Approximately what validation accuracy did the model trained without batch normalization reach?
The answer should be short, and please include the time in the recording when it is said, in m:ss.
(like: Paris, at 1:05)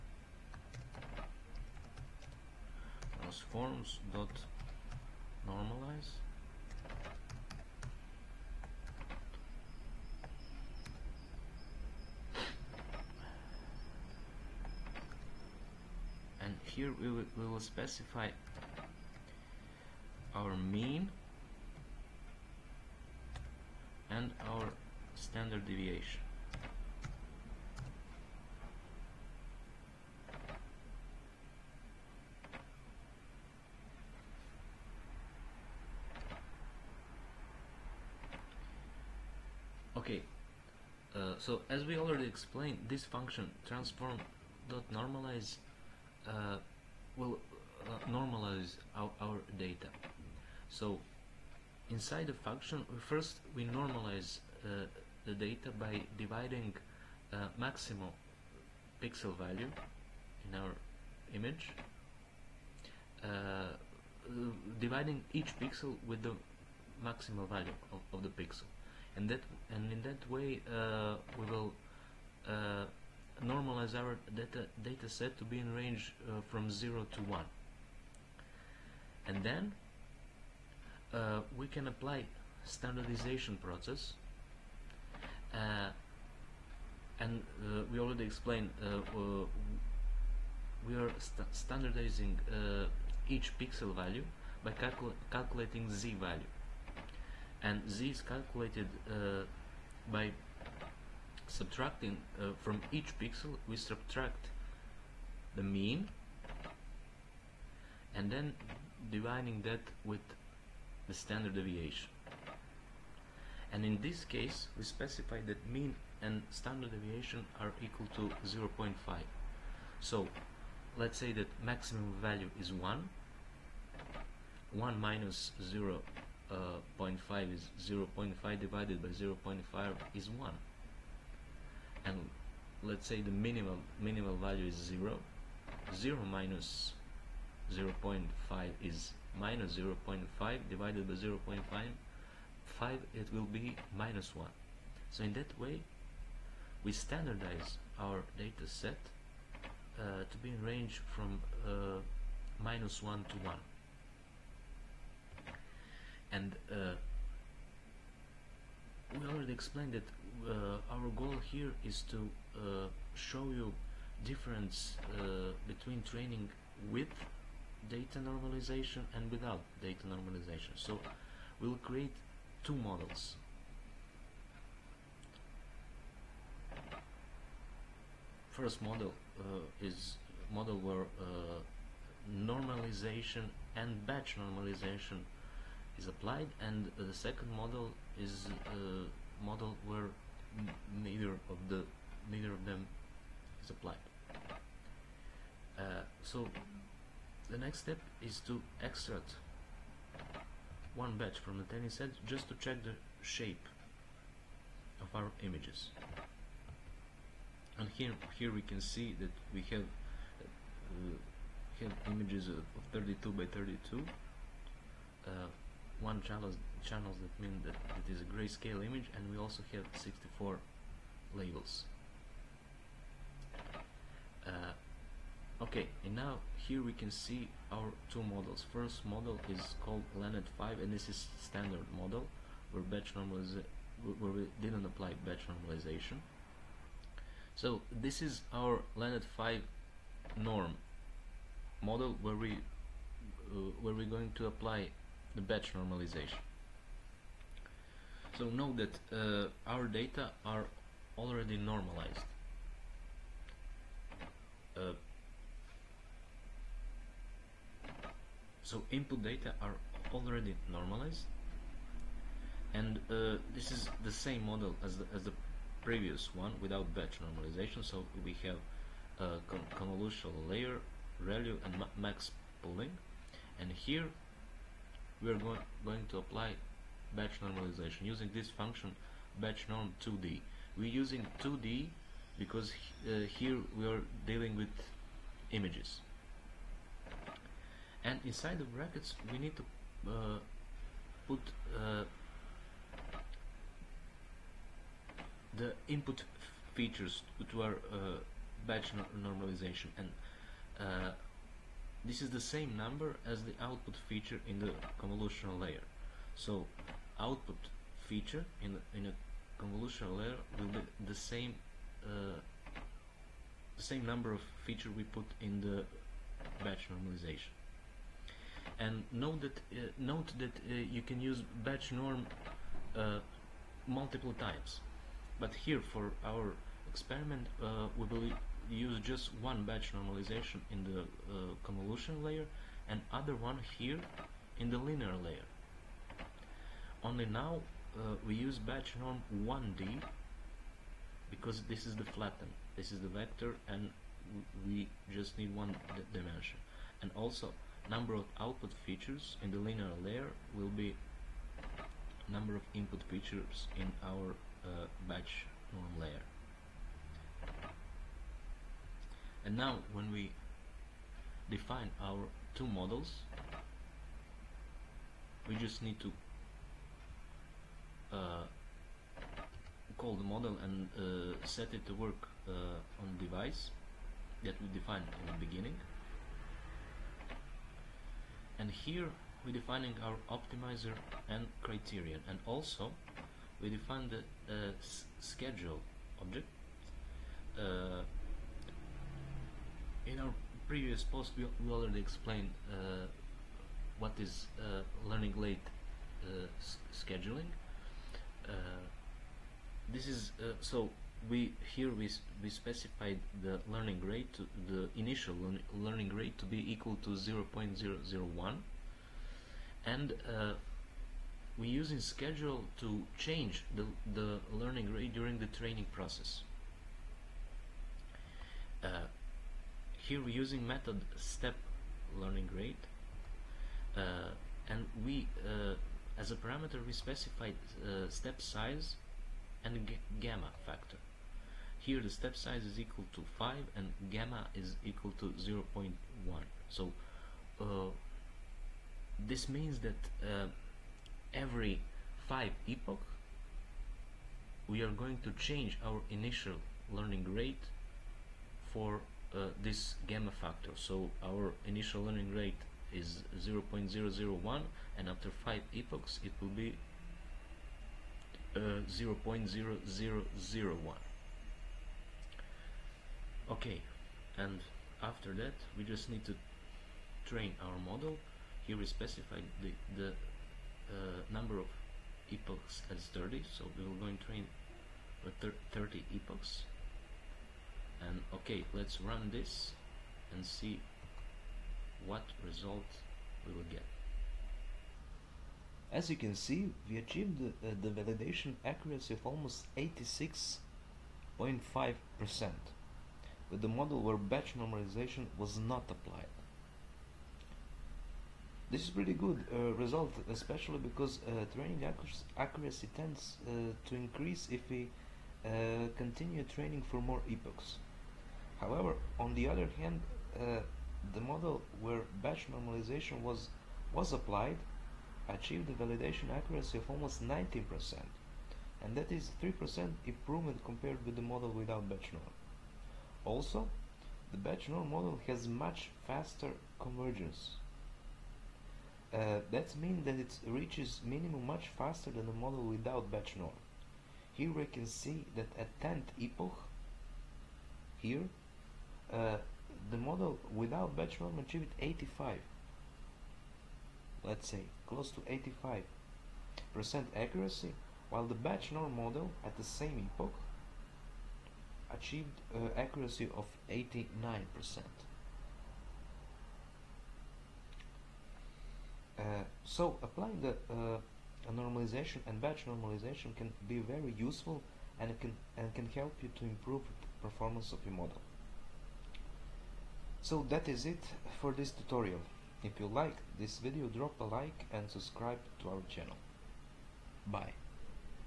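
86.5 percent, at 8:09.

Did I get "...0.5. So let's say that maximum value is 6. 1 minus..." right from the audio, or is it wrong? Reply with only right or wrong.
wrong.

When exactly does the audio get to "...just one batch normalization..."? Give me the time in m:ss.
5:29.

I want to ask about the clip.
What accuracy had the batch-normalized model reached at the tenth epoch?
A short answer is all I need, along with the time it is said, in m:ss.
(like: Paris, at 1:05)
89%, at 9:13.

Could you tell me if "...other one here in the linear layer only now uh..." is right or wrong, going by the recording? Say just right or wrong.
right.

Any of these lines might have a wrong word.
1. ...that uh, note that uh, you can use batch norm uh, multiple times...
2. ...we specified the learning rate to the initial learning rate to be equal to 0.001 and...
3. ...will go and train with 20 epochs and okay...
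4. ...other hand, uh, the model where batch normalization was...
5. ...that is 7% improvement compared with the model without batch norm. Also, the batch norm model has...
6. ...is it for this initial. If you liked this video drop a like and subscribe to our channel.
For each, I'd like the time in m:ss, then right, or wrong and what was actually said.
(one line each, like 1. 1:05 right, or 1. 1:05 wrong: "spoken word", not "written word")
1. 5:19 right
2. 6:42 right
3. 7:53 wrong: "30", not "20"
4. 8:29 right
5. 8:38 wrong: "3", not "7"
6. 9:30 wrong: "tutorial", not "initial".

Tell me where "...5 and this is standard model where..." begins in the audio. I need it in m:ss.
3:50.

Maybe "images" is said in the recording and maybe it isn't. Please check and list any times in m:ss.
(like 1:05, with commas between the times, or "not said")
1:01, 3:25, 3:32, 3:38, 4:45.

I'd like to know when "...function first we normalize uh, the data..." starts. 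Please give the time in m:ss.
0:52.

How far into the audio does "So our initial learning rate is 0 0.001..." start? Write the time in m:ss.
7:30.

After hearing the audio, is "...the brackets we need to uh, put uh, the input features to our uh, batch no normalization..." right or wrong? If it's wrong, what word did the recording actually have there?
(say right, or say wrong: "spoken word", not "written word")
right.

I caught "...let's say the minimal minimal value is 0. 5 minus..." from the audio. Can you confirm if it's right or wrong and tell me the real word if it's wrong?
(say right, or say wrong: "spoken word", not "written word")
wrong: "0", not "5".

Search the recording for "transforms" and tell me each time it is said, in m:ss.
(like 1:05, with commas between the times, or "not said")
0:03, 0:43.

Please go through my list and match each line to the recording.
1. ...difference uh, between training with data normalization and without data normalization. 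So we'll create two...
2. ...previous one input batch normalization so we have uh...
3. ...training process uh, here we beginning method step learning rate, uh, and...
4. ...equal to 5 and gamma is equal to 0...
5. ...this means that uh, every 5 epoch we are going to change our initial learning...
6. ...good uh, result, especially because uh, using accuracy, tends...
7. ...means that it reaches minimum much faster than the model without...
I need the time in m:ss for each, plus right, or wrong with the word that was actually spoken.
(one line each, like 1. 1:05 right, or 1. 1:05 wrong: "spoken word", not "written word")
1. 2:44 right
2. 4:25 wrong: "without", not "input"
3. 6:55 wrong: "using", not "beginning"
4. 7:12 right
5. 7:19 right
6. 8:19 wrong: "training", not "using"
7. 8:49 right.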